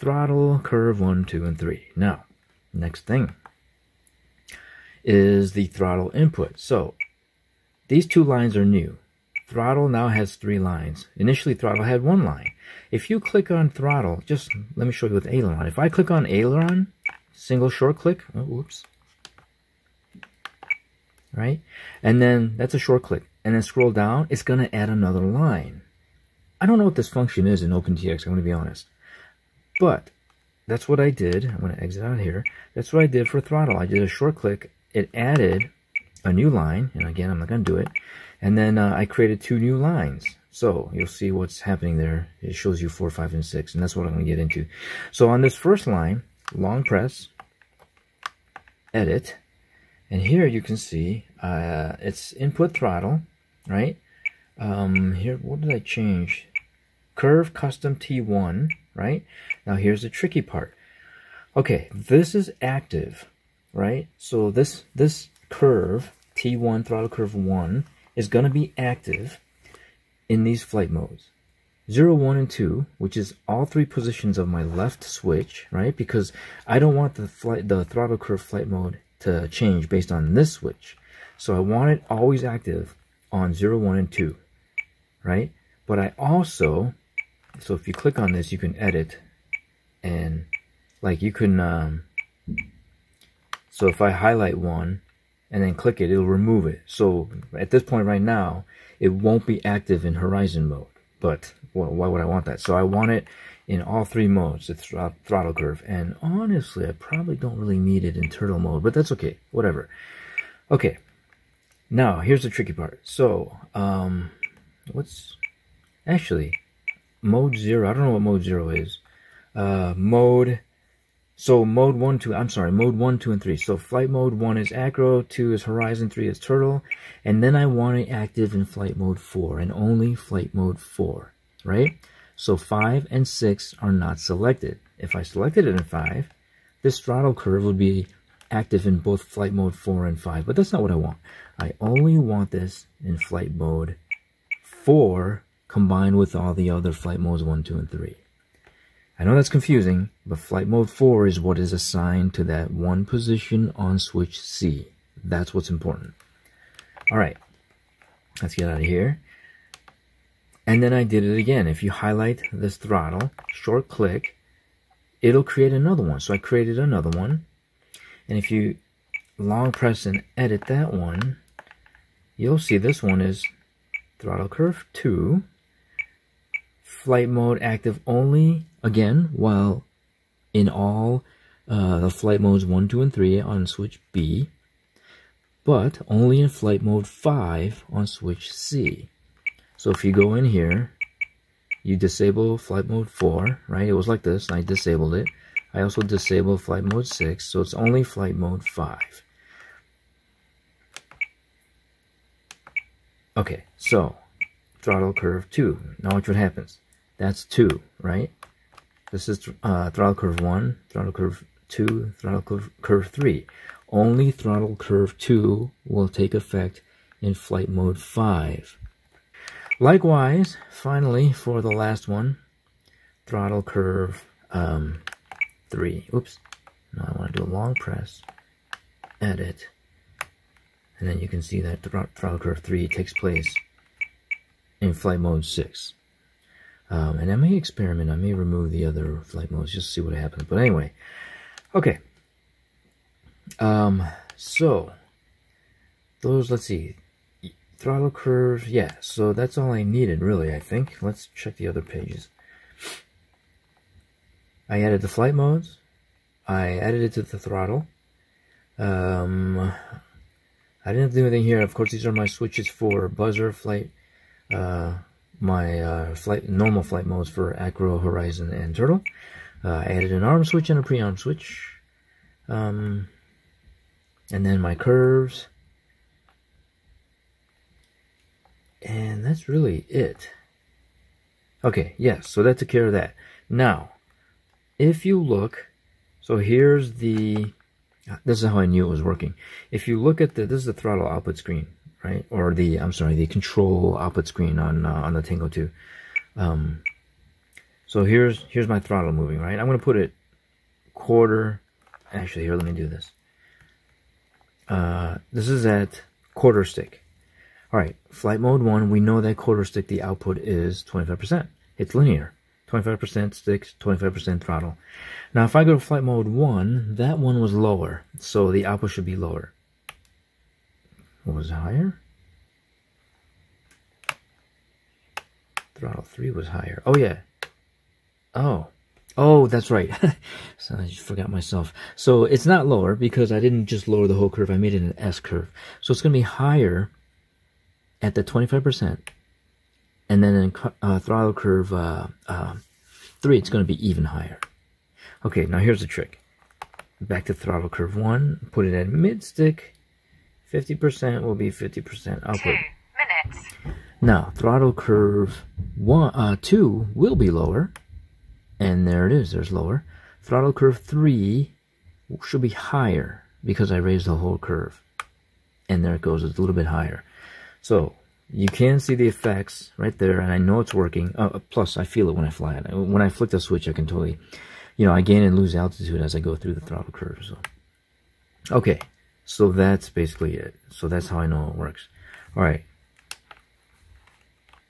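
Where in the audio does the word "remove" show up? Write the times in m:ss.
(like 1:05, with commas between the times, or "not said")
1:36, 3:58.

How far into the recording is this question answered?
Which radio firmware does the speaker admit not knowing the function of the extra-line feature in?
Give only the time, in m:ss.
0:27.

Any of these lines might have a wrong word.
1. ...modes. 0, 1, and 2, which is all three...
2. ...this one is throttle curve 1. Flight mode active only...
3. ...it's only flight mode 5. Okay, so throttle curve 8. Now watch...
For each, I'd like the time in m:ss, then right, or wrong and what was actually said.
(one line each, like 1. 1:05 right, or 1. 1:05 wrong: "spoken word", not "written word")
1. 1:10 right
2. 2:52 wrong: "2", not "1"
3. 3:17 wrong: "2", not "8".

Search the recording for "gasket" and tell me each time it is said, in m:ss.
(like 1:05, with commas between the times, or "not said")
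not said.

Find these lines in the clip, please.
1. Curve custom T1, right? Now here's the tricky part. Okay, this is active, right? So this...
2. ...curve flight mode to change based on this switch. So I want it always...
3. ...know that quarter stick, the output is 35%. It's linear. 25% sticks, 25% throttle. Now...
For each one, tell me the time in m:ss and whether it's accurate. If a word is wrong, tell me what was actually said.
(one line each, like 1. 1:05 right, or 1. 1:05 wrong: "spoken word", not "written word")
1. 0:57 right
2. 1:18 right
3. 5:09 wrong: "25", not "35".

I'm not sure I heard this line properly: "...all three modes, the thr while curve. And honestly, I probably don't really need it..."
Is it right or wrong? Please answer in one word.
wrong.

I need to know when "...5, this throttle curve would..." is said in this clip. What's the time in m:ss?
2:15.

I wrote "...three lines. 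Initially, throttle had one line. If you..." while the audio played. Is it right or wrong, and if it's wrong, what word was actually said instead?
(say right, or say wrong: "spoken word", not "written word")
right.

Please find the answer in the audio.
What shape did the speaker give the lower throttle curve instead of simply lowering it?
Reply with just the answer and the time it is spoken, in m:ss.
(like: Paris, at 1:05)
S curve, at 5:34.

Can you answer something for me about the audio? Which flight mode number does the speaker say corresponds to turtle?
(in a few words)
3.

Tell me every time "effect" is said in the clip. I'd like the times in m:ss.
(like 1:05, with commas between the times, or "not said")
3:36, 6:09.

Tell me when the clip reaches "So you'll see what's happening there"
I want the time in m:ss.
0:40.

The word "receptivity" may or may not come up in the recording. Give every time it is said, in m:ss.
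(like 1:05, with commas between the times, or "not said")
not said.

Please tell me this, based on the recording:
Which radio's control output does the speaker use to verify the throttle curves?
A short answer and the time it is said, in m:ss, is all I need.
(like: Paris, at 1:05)
Tango 2, at 4:55.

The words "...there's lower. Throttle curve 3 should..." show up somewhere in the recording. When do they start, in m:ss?
5:59.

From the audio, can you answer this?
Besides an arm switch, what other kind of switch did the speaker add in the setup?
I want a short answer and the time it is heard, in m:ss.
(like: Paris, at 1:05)
Pre-arm switch, at 4:30.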